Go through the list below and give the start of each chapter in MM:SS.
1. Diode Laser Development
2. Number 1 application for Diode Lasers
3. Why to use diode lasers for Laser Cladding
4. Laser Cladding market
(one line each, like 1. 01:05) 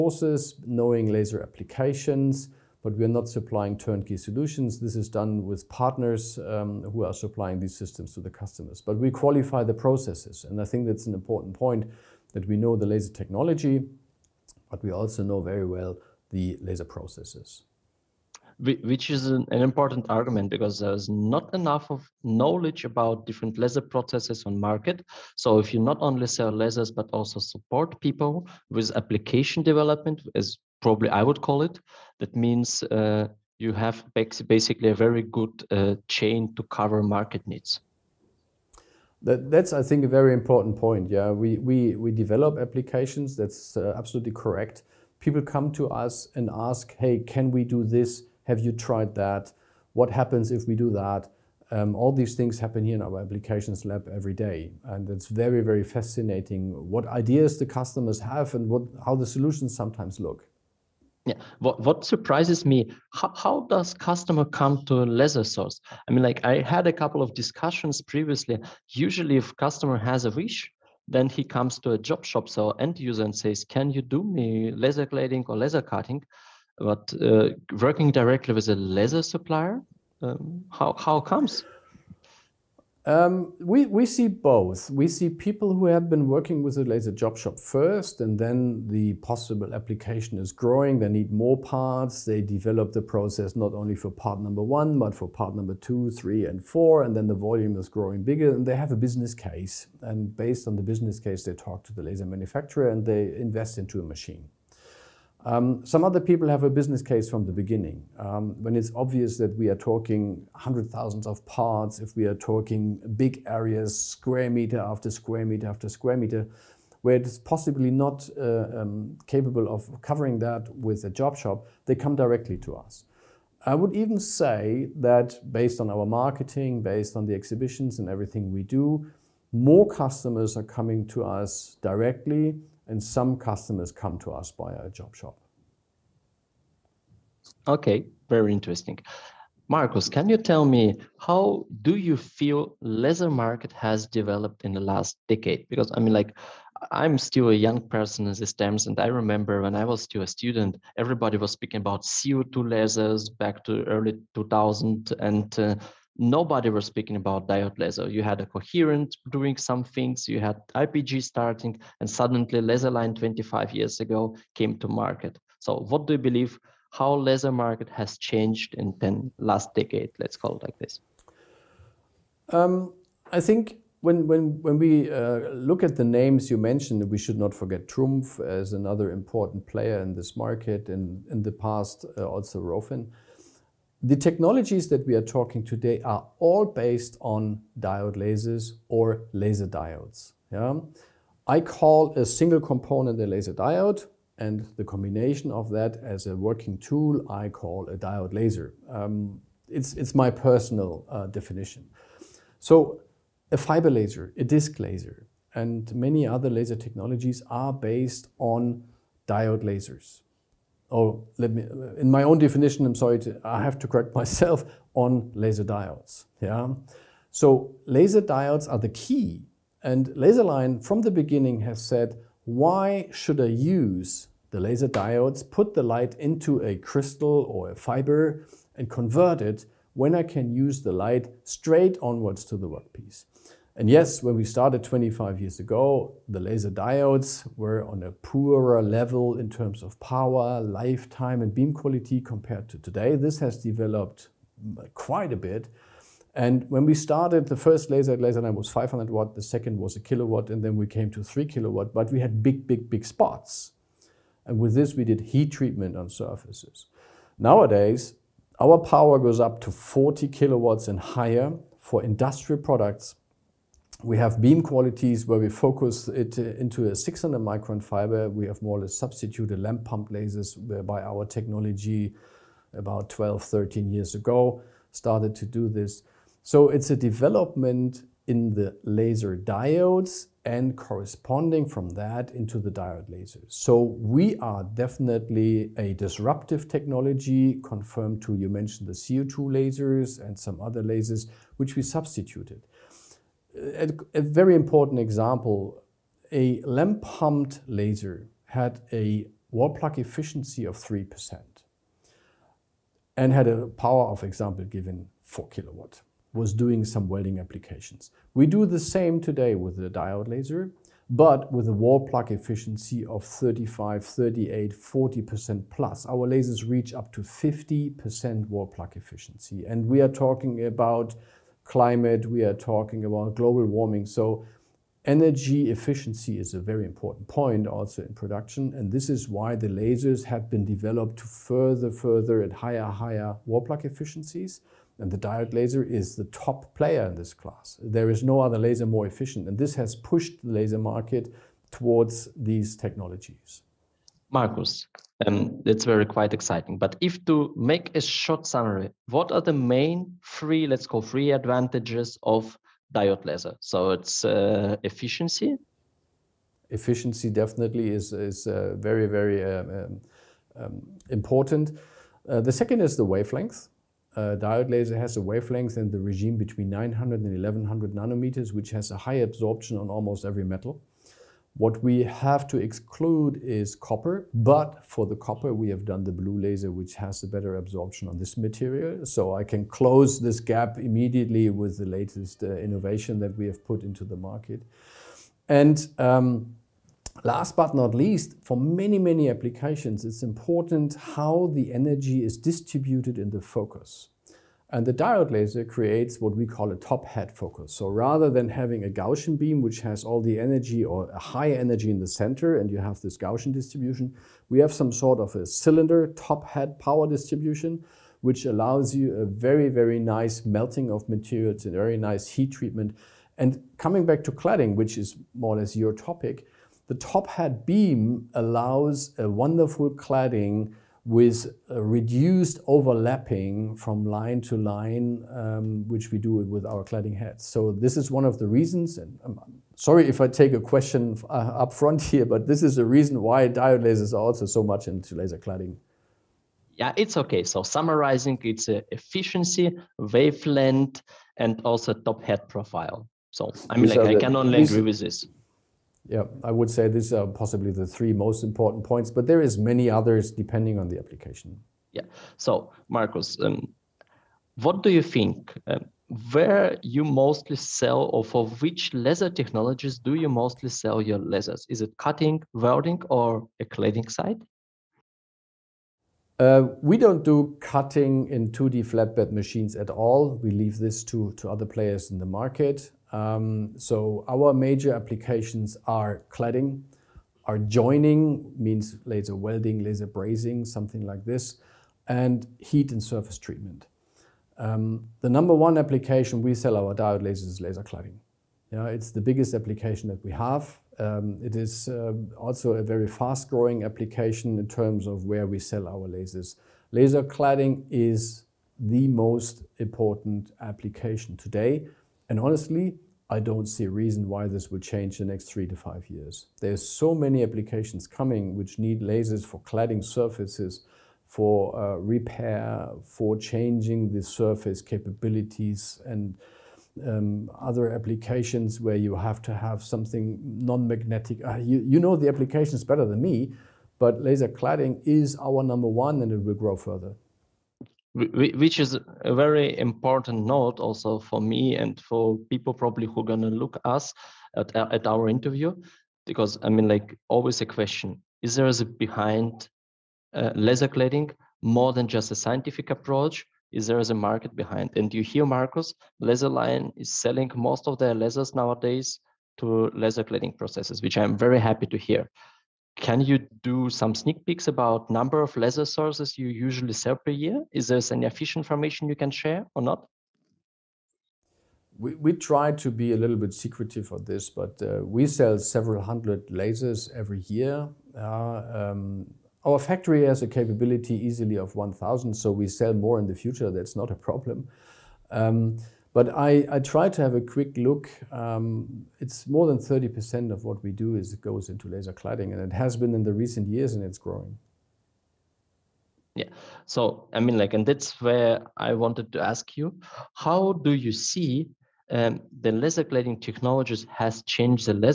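1. 02:21
2. 07:36
3. 05:46
4. 09:01.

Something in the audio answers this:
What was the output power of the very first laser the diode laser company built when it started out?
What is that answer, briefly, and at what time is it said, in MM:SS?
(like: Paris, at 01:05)
500 watt, at 04:08.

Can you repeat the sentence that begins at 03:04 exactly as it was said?
The technologies that we are talking today are all based on diode lasers or laser diodes.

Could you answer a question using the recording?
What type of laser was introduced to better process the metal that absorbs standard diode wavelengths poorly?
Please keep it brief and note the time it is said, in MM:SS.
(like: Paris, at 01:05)
blue laser, at 06:16.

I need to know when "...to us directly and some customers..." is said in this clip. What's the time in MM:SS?
02:11.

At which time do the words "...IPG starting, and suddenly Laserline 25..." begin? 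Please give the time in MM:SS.
02:40.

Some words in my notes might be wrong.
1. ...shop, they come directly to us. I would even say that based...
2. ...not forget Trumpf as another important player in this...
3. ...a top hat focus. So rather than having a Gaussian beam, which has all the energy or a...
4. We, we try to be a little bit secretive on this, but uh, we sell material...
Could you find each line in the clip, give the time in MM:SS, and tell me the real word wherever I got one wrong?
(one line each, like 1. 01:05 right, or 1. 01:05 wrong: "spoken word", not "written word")
1. 02:01 right
2. 02:57 right
3. 06:36 right
4. 09:21 wrong: "several", not "material".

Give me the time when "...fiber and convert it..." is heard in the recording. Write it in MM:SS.
03:47.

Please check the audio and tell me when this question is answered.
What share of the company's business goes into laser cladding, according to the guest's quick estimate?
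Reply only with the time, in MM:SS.
09:39.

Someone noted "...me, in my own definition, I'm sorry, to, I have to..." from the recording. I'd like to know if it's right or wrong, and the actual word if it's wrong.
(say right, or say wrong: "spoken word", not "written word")
right.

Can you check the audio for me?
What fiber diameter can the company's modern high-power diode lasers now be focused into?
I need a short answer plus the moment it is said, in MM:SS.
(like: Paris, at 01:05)
600 micron, at 04:26.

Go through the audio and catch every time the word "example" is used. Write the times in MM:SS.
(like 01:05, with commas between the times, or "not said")
04:54, 05:04.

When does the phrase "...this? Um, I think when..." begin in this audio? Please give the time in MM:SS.
02:50.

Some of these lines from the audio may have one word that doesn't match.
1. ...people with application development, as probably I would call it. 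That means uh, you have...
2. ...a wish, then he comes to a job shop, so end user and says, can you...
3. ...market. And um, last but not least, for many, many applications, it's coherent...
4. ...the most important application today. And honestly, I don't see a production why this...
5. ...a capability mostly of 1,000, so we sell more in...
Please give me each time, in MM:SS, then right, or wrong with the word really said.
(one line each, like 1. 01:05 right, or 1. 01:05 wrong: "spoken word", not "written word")
1. 00:27 right
2. 01:10 right
3. 06:24 wrong: "important", not "coherent"
4. 08:18 wrong: "reason", not "production"
5. 09:30 wrong: "easily", not "mostly".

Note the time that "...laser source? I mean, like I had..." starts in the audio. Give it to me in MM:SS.
01:05.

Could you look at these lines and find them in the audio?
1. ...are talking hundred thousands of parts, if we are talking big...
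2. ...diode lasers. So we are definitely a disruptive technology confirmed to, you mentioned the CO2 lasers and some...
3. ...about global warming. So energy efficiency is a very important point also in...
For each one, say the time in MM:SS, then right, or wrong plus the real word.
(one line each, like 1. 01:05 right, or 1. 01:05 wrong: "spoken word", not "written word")
1. 01:49 right
2. 04:42 right
3. 05:23 right.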